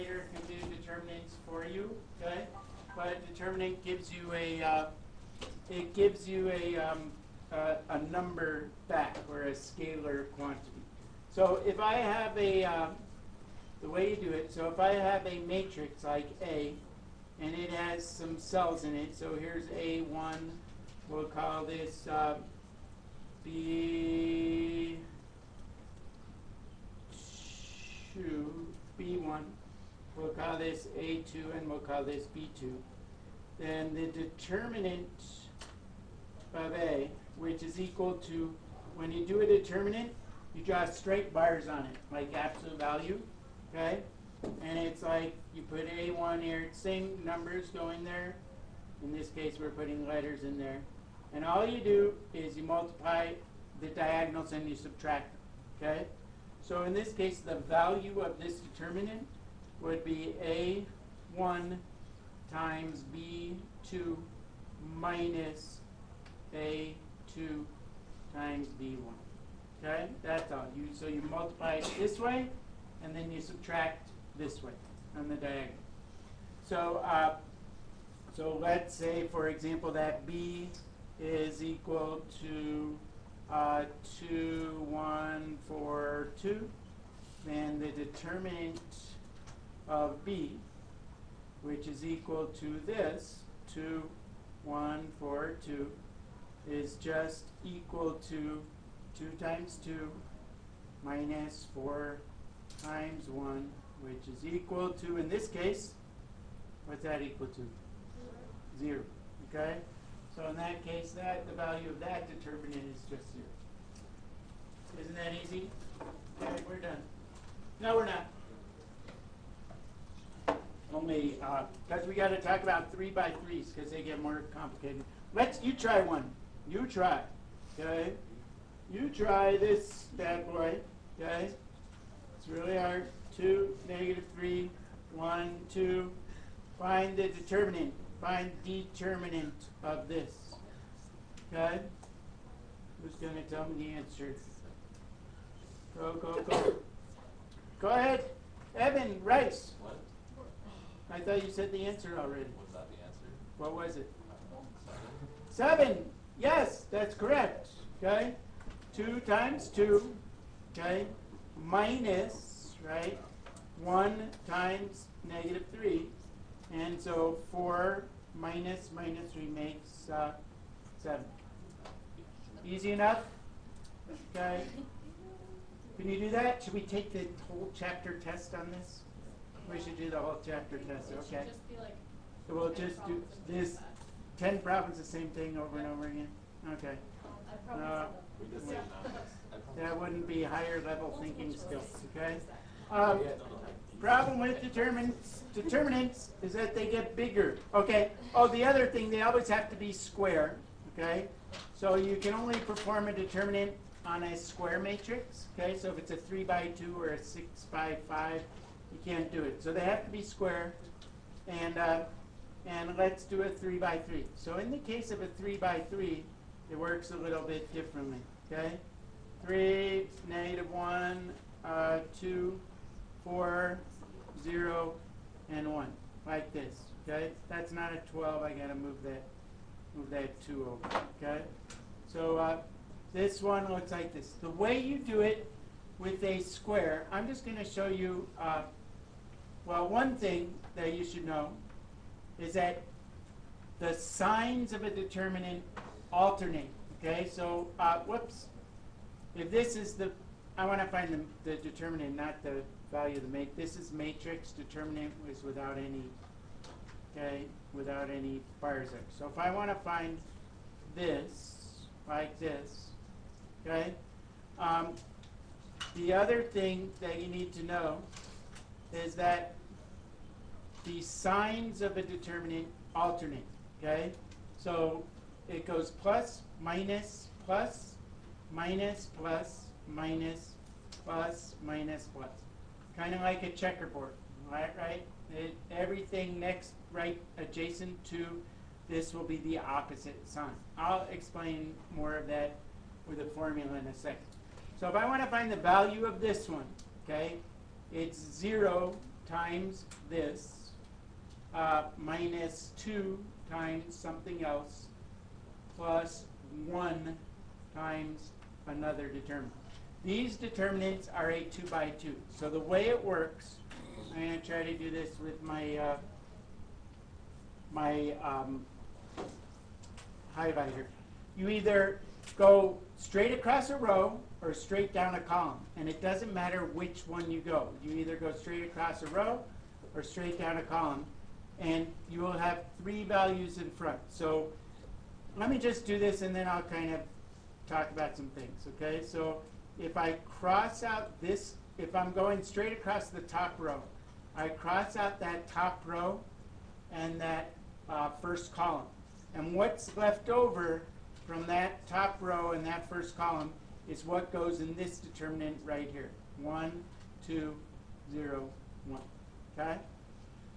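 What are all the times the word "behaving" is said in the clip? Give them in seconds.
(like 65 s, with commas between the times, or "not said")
not said.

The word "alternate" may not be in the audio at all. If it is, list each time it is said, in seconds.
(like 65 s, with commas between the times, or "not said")
246 s, 272 s.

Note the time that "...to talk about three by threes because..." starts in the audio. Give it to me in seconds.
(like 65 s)
122 s.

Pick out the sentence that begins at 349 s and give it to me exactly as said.
And what's left over from that top row and that first column is what goes in this determinant right here.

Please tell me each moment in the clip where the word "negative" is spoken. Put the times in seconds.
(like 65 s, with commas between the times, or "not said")
133 s, 165 s, 220 s.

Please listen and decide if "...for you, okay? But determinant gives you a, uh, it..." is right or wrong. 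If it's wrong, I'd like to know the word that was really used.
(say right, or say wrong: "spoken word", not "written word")
right.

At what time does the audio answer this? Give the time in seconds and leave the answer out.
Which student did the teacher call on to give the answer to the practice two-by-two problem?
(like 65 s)
148 s.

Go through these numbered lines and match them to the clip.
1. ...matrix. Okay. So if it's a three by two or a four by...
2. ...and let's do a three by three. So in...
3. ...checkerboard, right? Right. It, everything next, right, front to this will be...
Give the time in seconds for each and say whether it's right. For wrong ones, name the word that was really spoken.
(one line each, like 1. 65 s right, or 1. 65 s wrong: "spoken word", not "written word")
1. 204 s wrong: "six", not "four"
2. 212 s right
3. 283 s wrong: "adjacent", not "front".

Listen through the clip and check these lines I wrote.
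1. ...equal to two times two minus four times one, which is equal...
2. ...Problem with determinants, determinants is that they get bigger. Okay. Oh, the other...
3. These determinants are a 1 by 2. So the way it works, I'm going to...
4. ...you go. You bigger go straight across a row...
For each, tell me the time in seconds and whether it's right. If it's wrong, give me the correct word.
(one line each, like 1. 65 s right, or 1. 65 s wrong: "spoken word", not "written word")
1. 97 s right
2. 193 s right
3. 310 s wrong: "2", not "1"
4. 327 s wrong: "either", not "bigger".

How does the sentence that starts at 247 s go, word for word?
So, uh, whoops, if this is the, I wanna find the, the determinant, not the value of the matrix.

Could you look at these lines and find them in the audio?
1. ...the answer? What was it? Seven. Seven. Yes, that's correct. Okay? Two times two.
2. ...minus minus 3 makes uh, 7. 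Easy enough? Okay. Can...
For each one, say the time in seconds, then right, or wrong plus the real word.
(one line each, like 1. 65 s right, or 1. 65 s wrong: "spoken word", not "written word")
1. 152 s right
2. 168 s right.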